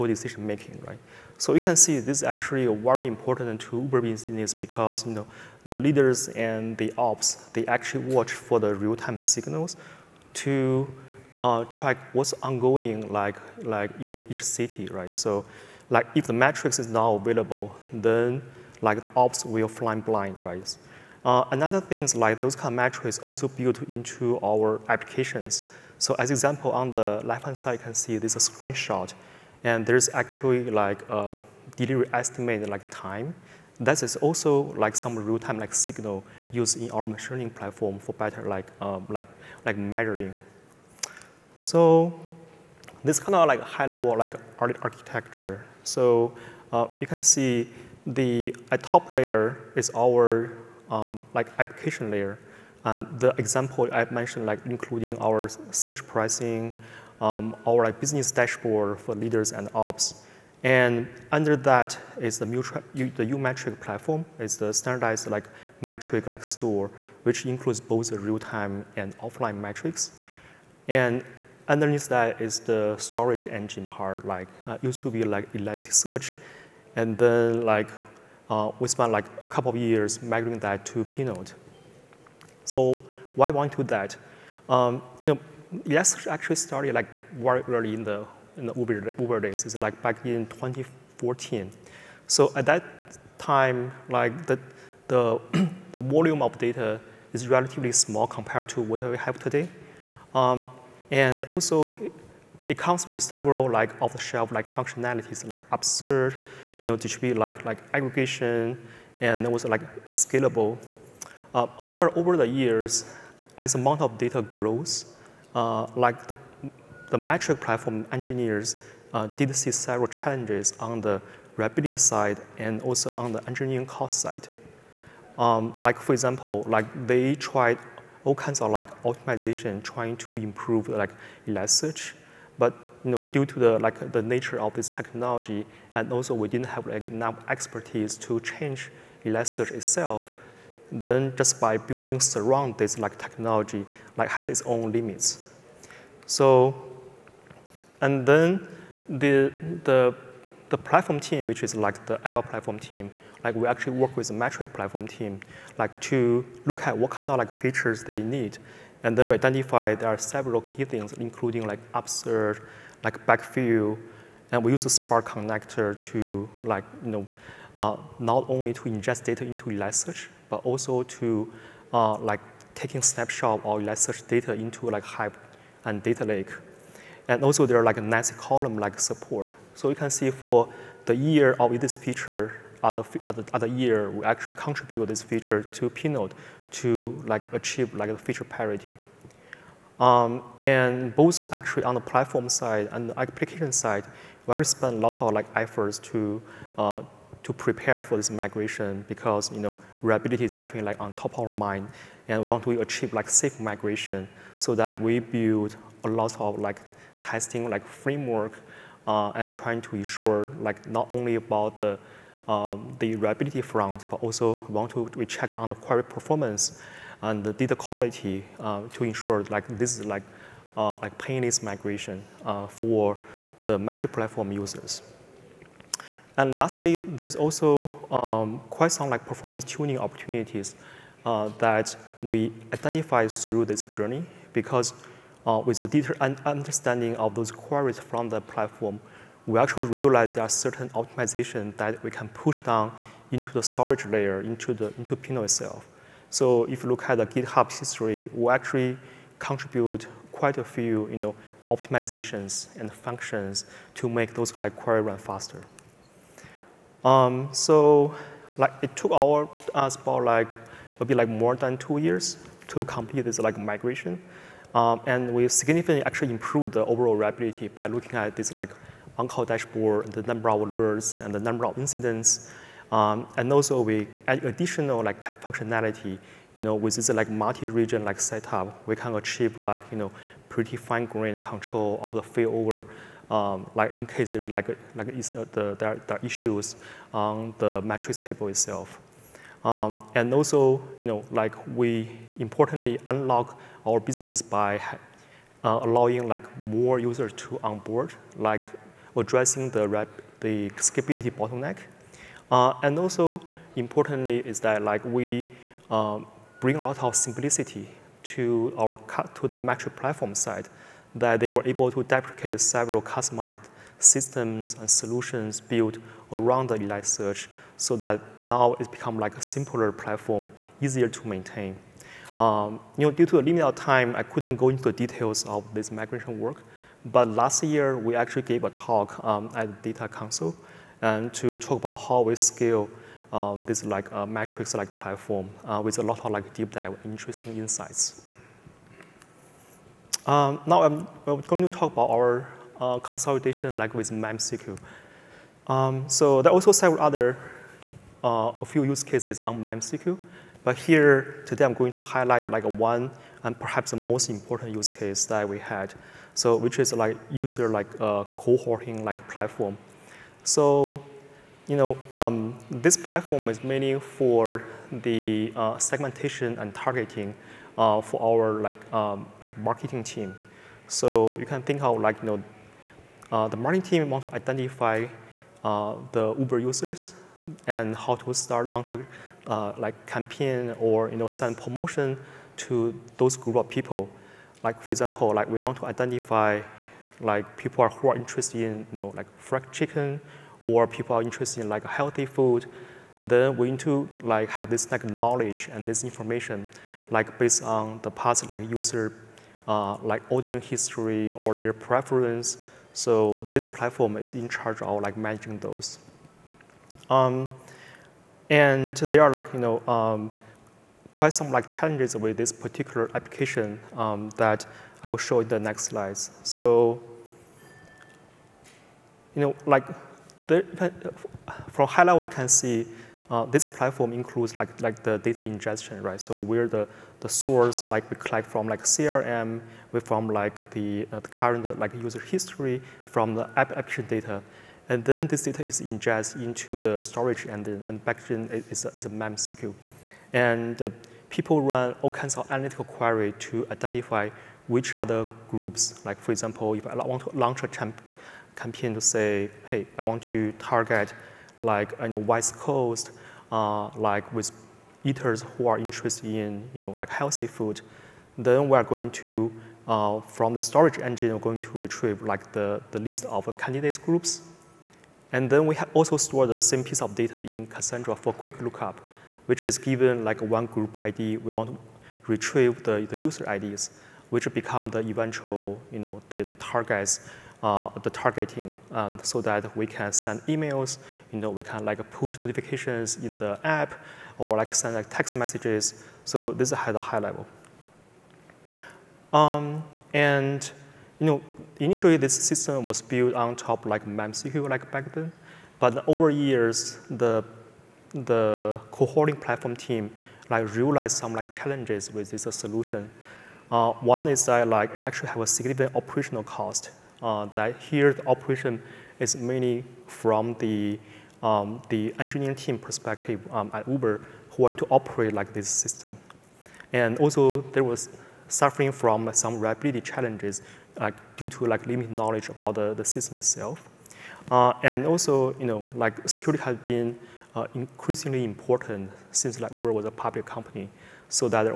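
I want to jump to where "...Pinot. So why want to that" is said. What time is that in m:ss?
1:21.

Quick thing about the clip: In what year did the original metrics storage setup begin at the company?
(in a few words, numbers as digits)
2014.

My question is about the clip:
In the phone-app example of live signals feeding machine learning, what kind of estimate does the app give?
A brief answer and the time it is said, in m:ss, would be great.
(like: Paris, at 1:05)
Delivery estimate, at 0:31.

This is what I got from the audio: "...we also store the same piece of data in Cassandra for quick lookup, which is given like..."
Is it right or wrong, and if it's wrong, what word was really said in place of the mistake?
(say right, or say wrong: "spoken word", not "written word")
right.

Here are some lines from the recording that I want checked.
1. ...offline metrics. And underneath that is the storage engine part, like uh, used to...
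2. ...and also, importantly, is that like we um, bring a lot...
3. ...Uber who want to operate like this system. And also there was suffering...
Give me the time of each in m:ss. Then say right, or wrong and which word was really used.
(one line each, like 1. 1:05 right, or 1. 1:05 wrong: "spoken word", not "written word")
1. 1:09 right
2. 5:02 right
3. 8:33 right.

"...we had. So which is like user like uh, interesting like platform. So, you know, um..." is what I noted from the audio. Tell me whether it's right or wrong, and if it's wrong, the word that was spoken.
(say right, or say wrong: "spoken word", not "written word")
wrong: "cohorting", not "interesting".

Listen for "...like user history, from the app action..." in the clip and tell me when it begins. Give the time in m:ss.
7:11.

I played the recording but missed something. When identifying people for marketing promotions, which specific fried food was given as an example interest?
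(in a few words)
Fried chicken.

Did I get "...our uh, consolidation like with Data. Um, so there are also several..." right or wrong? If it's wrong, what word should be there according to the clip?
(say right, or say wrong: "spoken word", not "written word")
wrong: "MemSQL", not "Data".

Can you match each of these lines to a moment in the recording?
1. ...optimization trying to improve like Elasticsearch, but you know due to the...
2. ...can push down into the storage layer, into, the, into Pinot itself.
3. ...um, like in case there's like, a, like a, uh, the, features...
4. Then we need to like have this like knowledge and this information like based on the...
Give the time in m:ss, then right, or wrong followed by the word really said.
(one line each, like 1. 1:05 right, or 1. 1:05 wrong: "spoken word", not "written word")
1. 2:09 right
2. 4:02 right
3. 4:43 wrong: "issues", not "features"
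4. 6:33 right.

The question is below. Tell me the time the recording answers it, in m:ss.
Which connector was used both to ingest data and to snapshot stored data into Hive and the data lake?
2:44.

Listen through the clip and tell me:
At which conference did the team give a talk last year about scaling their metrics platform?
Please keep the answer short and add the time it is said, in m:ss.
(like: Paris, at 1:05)
Data Council, at 5:29.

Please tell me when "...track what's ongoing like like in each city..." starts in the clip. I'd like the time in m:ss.
0:11.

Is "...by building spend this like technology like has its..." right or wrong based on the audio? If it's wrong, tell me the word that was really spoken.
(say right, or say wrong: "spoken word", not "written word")
wrong: "surround", not "spend".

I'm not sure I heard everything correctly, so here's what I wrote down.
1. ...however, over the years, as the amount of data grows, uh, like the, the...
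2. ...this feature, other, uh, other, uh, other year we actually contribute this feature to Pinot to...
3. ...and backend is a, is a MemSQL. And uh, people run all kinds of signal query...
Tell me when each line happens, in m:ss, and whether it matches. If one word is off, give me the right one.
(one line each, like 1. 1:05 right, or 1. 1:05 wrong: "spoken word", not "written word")
1. 1:51 right
2. 3:01 right
3. 7:17 wrong: "analytical", not "signal".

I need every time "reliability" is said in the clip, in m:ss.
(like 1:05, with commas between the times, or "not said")
3:20, 3:33, 4:27, 8:39.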